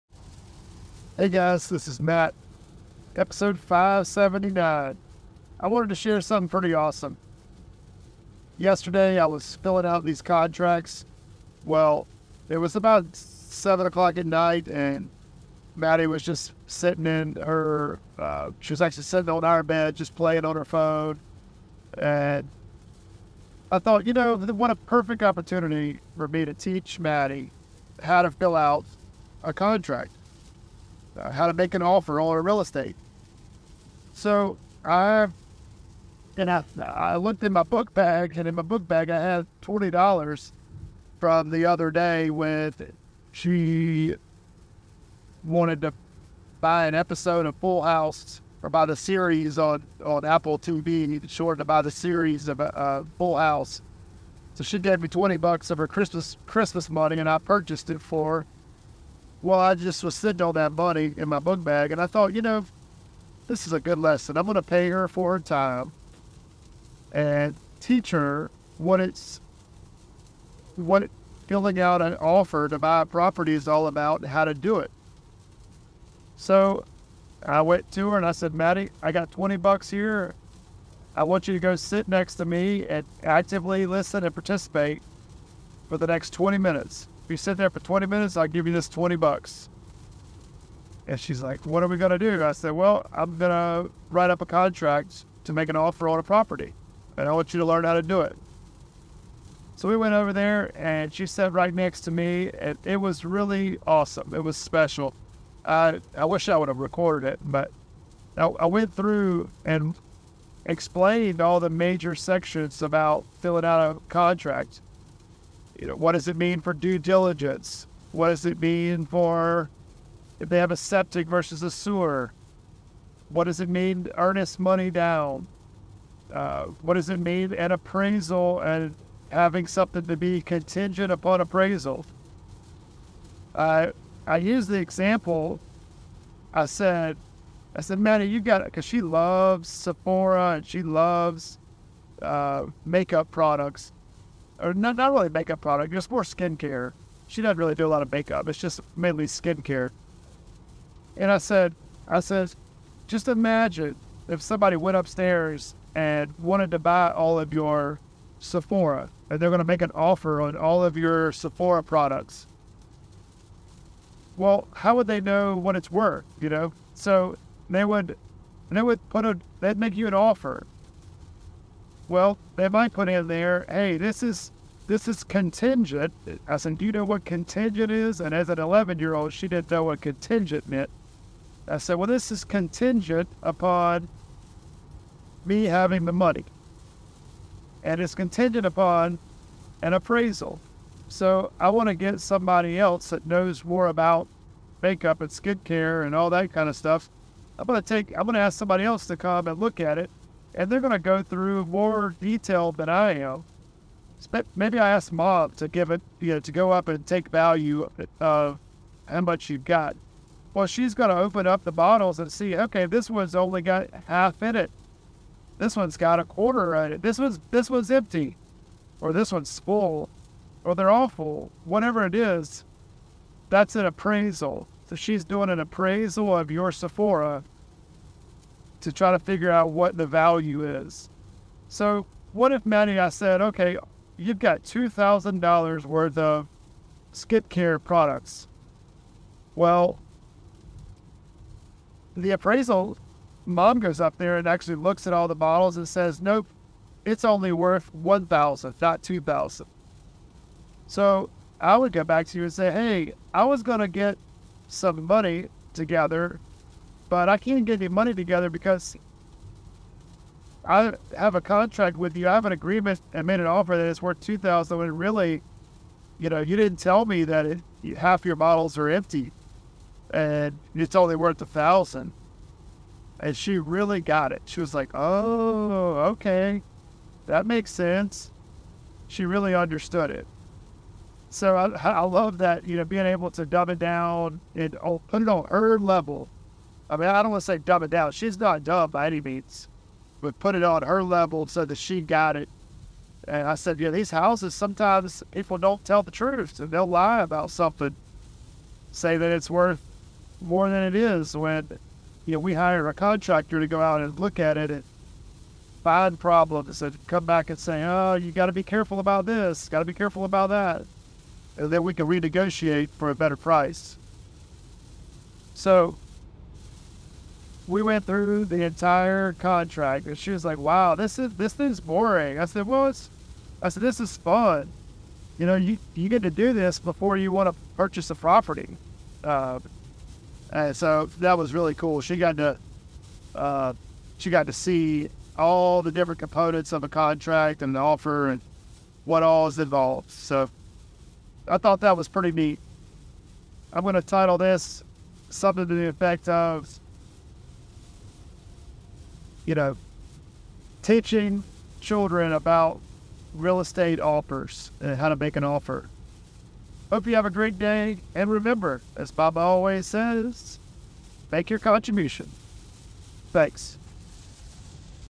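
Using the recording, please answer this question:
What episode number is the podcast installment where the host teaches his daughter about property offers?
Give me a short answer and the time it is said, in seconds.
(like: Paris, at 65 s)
579, at 3 s.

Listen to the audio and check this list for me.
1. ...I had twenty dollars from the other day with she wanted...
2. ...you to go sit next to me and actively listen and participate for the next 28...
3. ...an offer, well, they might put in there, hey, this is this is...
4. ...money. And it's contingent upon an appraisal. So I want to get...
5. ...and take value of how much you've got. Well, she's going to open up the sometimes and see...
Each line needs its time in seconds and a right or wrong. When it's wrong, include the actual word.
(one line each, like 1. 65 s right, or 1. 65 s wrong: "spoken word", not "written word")
1. 39 s right
2. 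81 s wrong: "20", not "28"
3. 170 s right
4. 186 s right
5. 206 s wrong: "bottles", not "sometimes".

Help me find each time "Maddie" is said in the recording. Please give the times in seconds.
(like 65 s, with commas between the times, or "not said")
15 s, 26 s, 78 s, 137 s, 232 s.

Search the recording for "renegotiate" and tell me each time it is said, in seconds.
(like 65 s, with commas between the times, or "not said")
312 s.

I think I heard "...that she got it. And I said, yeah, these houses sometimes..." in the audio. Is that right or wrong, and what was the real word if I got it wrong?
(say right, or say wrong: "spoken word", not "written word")
right.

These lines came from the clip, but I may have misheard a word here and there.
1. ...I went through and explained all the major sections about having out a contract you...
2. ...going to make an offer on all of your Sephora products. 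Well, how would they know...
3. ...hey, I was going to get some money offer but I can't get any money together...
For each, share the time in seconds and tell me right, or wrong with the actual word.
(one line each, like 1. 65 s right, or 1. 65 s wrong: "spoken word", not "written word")
1. 108 s wrong: "filling", not "having"
2. 159 s right
3. 252 s wrong: "together", not "offer".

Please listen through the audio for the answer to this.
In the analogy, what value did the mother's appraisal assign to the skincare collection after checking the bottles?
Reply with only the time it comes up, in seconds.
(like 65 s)
247 s.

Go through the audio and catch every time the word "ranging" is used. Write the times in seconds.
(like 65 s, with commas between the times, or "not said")
not said.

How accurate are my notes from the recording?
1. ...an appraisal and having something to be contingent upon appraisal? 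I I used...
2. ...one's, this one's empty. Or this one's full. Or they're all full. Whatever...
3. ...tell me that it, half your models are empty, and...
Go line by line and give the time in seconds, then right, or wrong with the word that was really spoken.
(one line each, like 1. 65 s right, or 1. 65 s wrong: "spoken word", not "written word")
1. 127 s right
2. 217 s right
3. 266 s right.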